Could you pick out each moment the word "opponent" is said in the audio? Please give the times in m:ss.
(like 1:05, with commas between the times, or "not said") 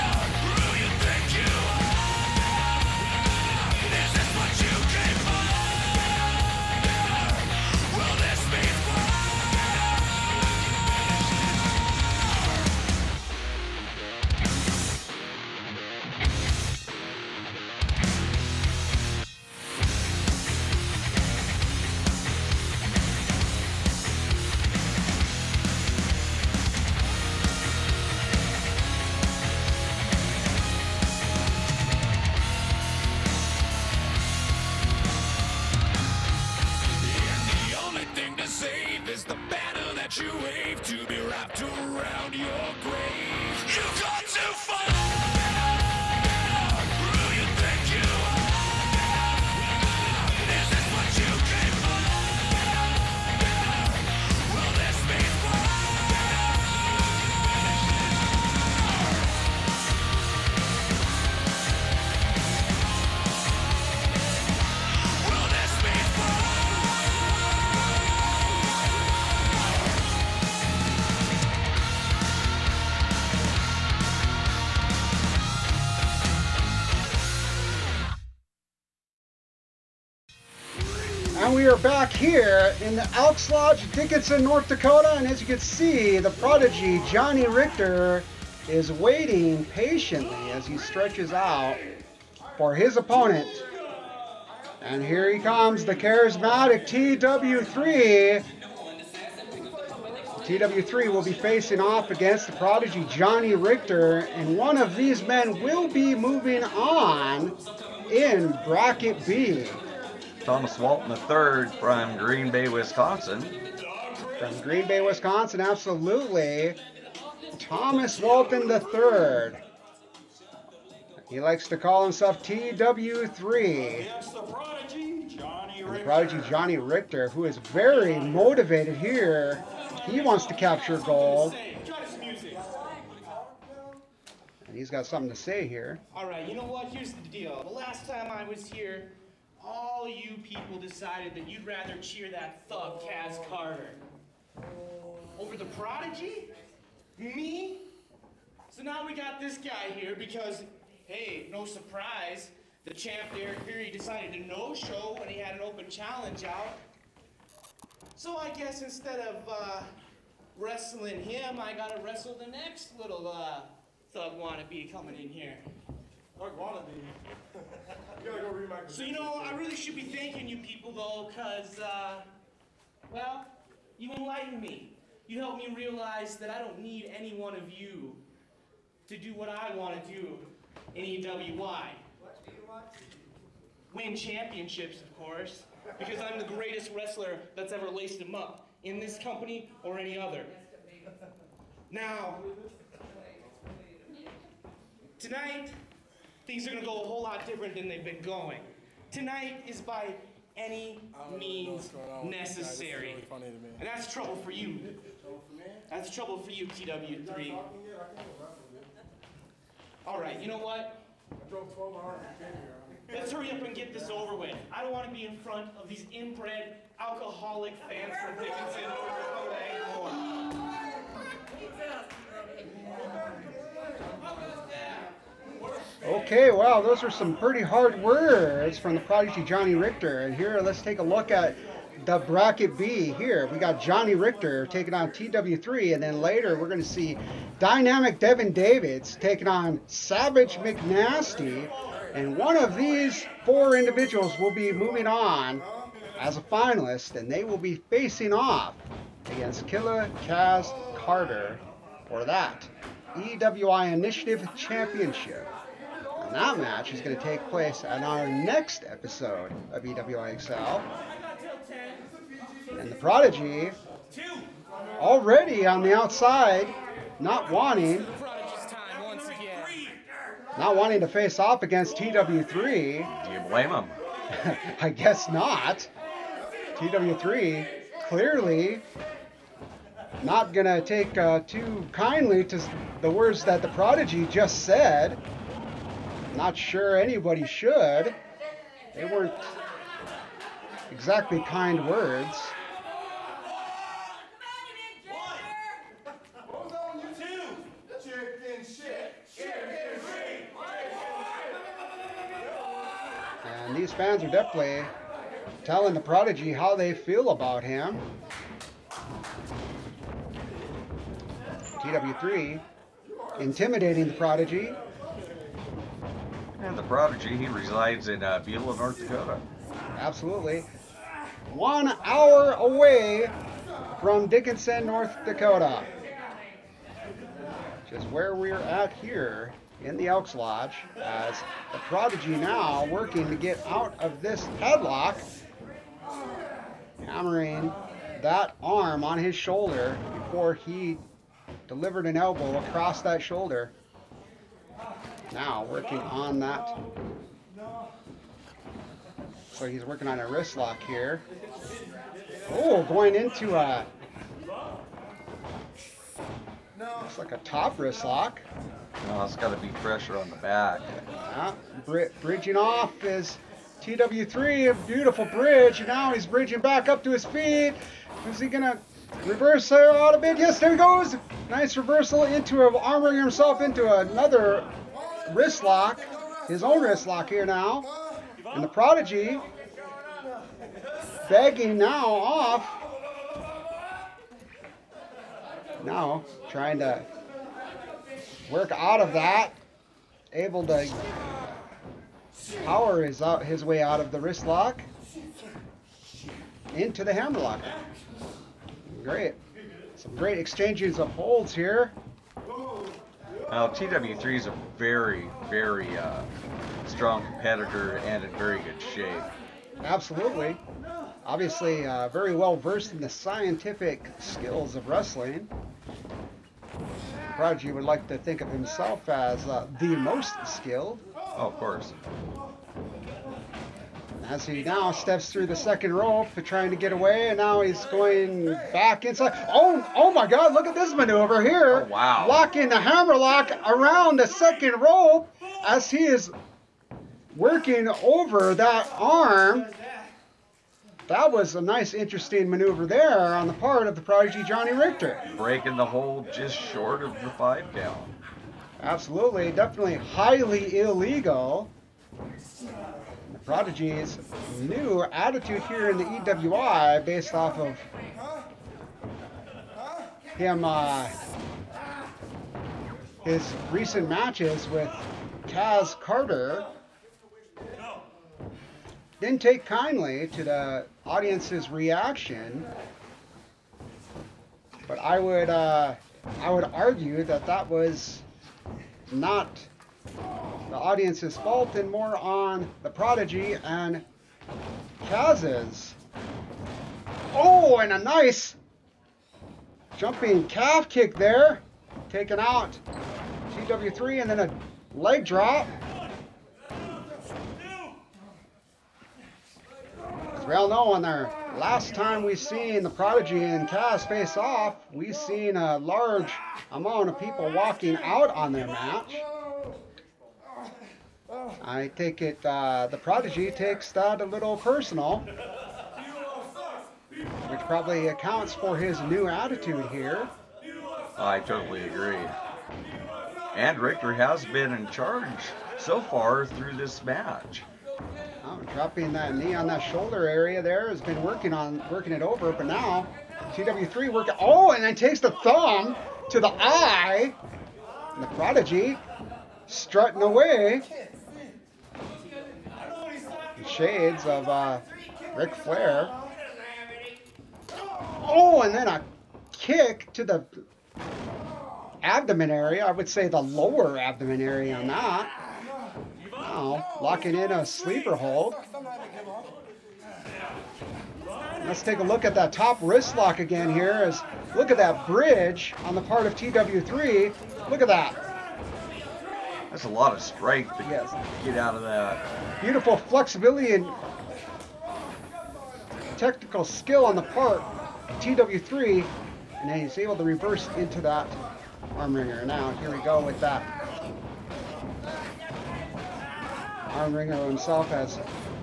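1:32.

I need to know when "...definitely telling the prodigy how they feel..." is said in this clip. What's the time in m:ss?
5:04.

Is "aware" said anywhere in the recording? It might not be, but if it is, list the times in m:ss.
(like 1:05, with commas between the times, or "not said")
not said.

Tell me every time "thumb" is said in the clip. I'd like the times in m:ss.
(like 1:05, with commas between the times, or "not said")
8:55.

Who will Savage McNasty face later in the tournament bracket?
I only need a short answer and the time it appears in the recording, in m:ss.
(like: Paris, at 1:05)
Devin Davids, at 3:57.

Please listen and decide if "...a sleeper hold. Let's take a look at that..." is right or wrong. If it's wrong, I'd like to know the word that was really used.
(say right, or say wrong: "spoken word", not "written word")
right.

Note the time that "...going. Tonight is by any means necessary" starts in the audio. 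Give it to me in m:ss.
3:18.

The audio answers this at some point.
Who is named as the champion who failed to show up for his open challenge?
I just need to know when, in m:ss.
2:33.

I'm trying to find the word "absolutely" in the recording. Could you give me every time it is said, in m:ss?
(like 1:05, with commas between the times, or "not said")
1:55, 5:19, 6:49, 7:28.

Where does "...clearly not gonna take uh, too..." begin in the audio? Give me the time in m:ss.
4:38.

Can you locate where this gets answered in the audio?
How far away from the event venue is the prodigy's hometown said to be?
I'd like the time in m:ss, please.
5:21.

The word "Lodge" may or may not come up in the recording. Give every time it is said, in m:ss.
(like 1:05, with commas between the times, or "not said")
1:23, 5:30.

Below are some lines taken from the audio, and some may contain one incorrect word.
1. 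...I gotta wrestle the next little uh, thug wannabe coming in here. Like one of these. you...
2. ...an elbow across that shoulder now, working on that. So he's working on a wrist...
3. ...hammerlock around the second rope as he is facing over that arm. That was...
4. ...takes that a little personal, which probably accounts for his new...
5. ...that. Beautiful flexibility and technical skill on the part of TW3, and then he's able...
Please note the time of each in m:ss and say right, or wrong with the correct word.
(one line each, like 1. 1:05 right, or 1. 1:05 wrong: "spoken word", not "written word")
1. 2:41 right
2. 5:42 right
3. 7:12 wrong: "working", not "facing"
4. 8:33 right
5. 9:31 right.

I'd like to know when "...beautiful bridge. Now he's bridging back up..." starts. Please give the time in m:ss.
6:04.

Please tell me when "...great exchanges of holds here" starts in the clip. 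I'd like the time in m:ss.
6:40.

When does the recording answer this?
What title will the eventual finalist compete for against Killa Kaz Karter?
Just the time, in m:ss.
4:13.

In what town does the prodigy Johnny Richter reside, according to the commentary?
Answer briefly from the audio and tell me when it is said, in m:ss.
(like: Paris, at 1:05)
Beulah, North Dakota, at 5:18.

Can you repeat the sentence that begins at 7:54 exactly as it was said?
But I would, uh, I would argue that that was not the audience's fault and more on the Prodigy and Kaz's.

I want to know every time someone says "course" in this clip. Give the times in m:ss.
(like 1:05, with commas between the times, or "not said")
3:05, 7:01.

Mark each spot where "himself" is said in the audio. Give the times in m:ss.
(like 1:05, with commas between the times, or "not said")
2:02, 6:13, 6:58, 9:47.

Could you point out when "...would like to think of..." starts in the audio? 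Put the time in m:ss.
6:57.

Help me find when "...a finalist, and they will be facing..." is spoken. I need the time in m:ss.
4:06.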